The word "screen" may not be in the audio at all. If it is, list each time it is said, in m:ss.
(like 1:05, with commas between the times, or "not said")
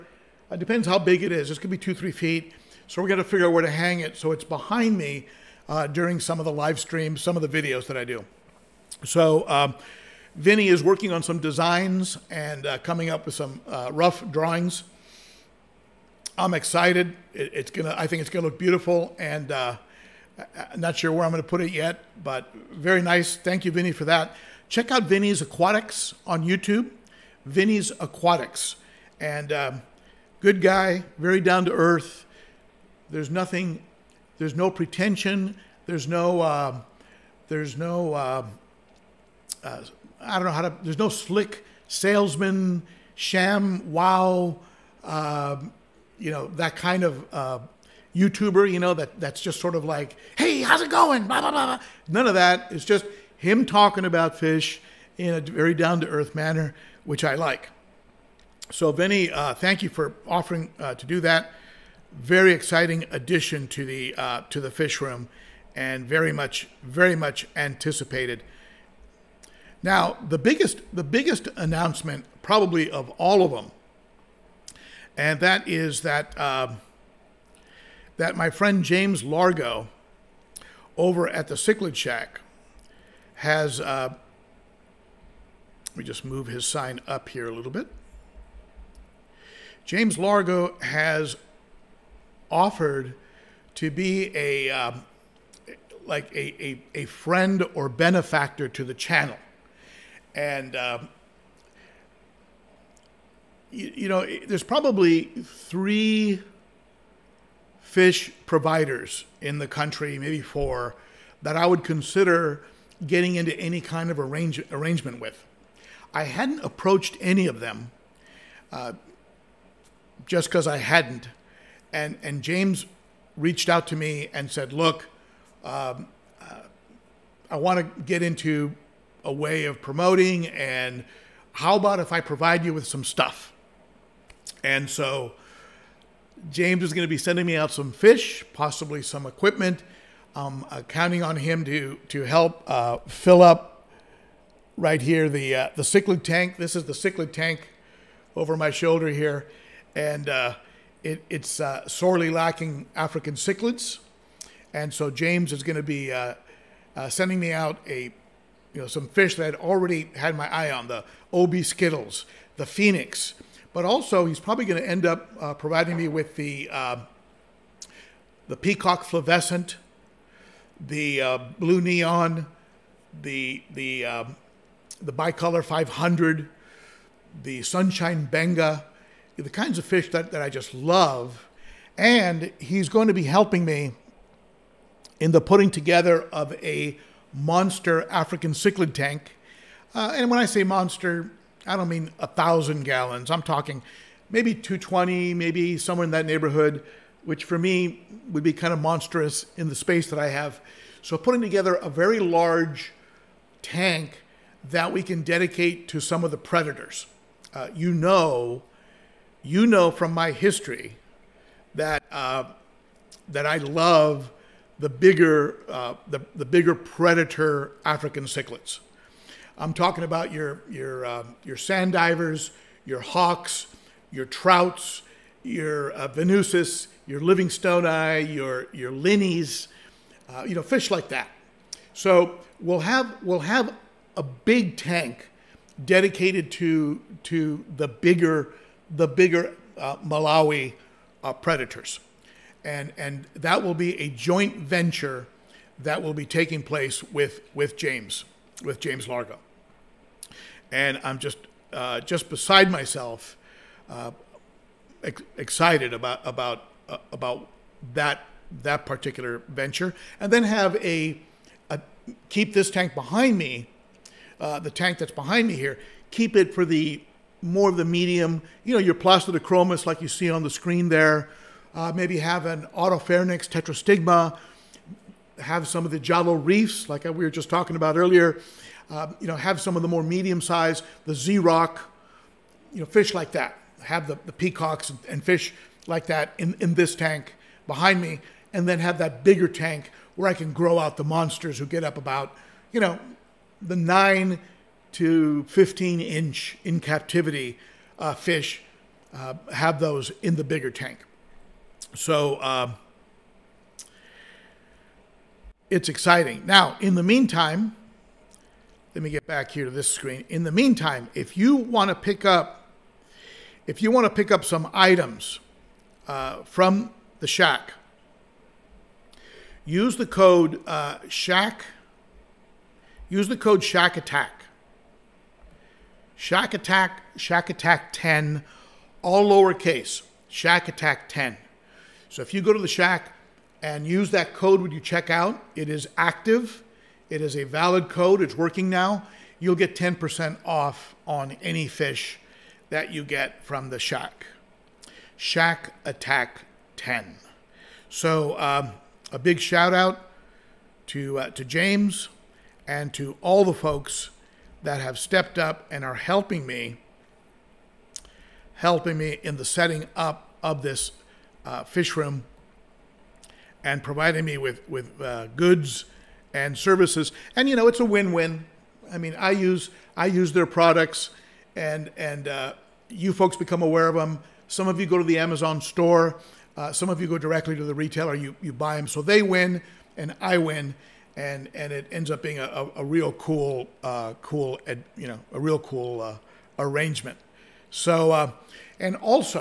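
4:30, 5:09.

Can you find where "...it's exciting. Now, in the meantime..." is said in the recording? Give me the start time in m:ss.
5:05.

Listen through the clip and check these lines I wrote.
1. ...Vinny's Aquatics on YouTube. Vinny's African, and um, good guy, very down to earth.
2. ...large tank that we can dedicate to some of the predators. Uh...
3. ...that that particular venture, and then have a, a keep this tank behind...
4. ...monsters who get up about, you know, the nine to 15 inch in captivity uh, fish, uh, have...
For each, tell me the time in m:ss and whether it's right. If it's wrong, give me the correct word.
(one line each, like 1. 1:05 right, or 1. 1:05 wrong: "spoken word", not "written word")
1. 0:25 wrong: "Aquatics", not "African"
2. 3:22 right
3. 4:17 right
4. 4:51 right.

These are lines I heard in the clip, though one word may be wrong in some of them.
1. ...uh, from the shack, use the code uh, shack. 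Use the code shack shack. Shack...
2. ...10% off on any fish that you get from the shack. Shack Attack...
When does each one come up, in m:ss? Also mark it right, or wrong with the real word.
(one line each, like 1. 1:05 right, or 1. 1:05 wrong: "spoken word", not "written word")
1. 5:16 wrong: "attack", not "shack"
2. 5:39 right.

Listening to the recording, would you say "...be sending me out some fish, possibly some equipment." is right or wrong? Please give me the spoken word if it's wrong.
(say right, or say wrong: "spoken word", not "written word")
right.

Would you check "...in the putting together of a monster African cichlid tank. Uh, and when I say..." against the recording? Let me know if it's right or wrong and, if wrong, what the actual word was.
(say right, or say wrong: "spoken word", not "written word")
right.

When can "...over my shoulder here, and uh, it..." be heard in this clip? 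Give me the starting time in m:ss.
2:28.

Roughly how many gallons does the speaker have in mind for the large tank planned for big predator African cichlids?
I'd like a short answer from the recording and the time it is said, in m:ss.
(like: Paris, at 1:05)
220, at 3:14.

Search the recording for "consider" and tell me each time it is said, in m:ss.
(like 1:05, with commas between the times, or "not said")
1:51.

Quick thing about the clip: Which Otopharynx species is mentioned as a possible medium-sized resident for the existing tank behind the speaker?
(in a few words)
tetrastigma.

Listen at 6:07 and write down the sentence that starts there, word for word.
And you know, it's a win-win.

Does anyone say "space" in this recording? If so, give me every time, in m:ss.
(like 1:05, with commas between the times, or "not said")
3:19.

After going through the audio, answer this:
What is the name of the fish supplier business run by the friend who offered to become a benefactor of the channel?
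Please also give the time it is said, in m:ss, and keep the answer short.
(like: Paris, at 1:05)
Cichlid Shack, at 1:21.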